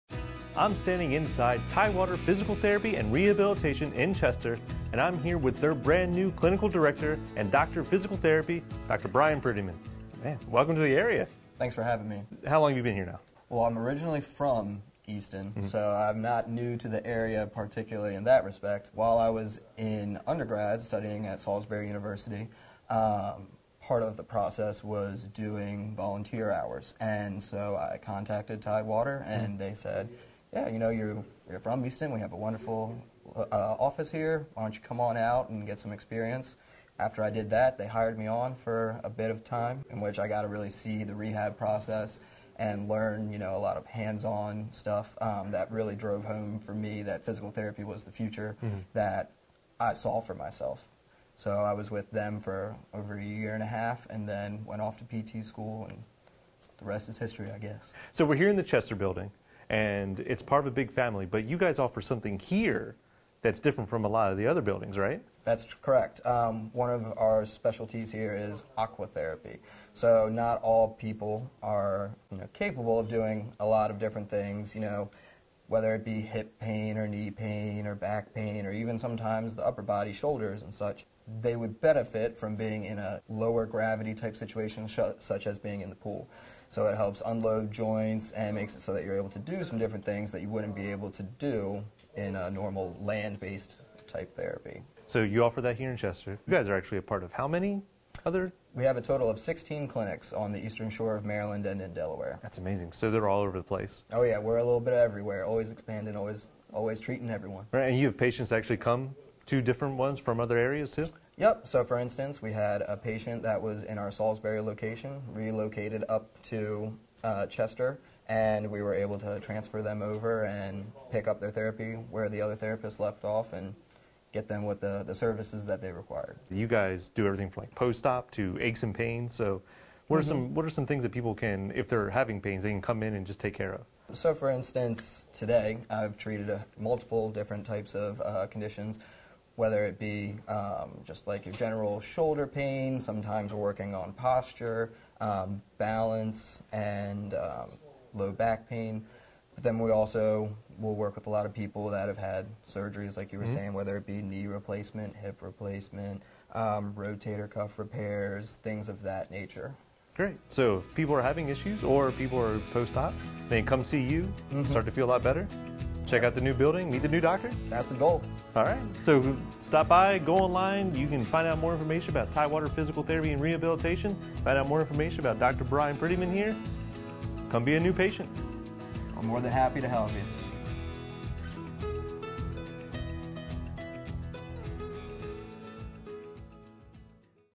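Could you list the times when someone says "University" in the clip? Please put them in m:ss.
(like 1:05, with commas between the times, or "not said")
0:21.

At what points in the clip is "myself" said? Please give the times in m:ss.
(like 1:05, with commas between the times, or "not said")
0:50.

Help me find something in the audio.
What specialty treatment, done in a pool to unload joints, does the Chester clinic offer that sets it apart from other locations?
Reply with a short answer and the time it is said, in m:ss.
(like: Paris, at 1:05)
Aquatherapy, at 1:08.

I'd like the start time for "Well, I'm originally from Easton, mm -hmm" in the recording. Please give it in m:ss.
0:13.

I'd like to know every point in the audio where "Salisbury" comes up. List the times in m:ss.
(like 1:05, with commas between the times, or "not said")
0:21, 1:54.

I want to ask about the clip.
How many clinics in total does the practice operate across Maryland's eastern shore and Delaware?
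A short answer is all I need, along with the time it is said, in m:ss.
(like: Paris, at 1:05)
16, at 1:39.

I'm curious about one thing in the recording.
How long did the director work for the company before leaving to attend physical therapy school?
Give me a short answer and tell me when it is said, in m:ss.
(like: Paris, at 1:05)
Over a year and a half, at 0:52.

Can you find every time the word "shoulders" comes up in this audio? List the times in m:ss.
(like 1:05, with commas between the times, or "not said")
1:20, 2:22.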